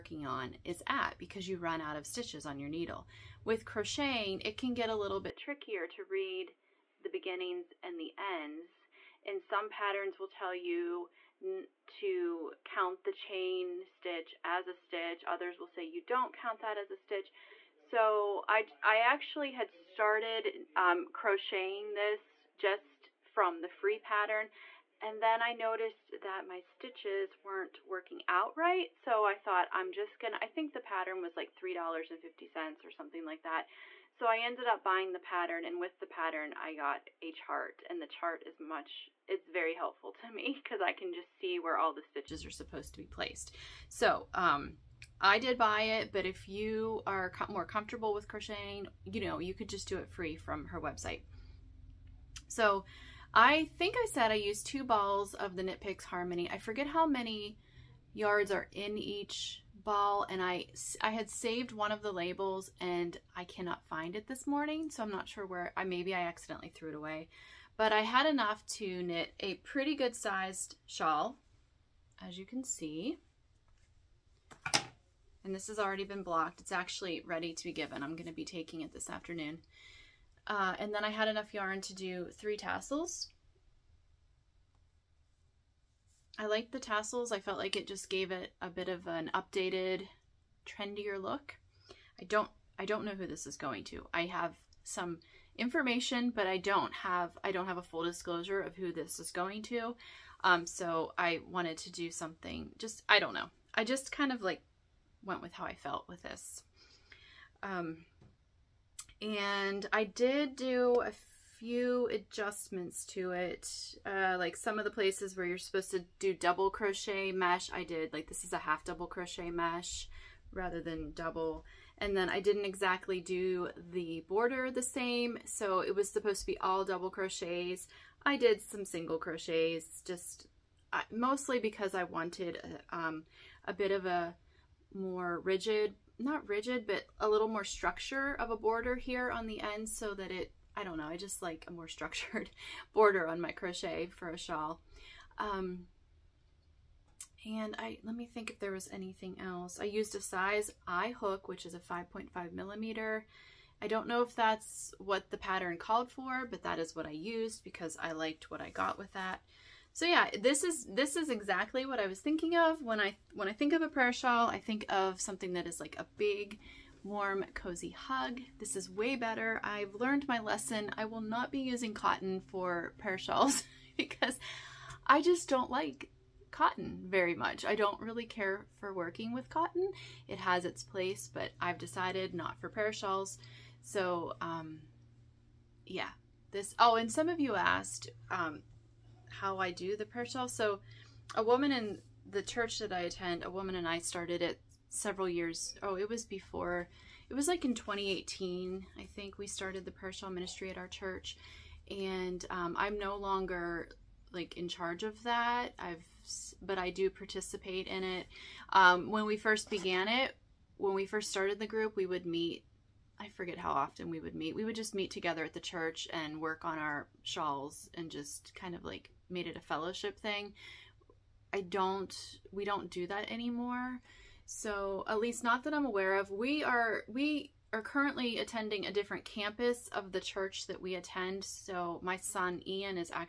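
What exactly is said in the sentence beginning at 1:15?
And this has already been blocked.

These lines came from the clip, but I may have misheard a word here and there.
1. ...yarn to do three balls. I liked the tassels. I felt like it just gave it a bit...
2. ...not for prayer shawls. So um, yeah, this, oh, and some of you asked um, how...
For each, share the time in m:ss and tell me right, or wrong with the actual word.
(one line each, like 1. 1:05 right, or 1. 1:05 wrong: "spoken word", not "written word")
1. 1:21 wrong: "tassels", not "balls"
2. 3:02 right.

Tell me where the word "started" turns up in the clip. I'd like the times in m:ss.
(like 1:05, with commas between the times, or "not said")
0:19, 3:13, 3:19, 3:31.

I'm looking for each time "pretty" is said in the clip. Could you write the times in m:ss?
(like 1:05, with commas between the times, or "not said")
1:09.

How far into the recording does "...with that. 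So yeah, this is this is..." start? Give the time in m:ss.
2:38.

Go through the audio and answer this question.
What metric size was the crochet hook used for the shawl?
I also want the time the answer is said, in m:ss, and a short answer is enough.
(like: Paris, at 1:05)
5.5 millimeter, at 2:31.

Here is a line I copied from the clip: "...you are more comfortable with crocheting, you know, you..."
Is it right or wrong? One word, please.
right.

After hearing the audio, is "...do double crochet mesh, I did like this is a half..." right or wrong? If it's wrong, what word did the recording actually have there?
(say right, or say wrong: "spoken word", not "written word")
right.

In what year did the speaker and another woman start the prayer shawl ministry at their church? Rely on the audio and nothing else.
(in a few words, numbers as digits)
2018.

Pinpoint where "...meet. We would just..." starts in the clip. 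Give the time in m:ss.
3:34.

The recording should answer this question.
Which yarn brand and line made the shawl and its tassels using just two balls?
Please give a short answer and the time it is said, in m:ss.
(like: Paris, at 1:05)
Knit Picks Harmony, at 0:55.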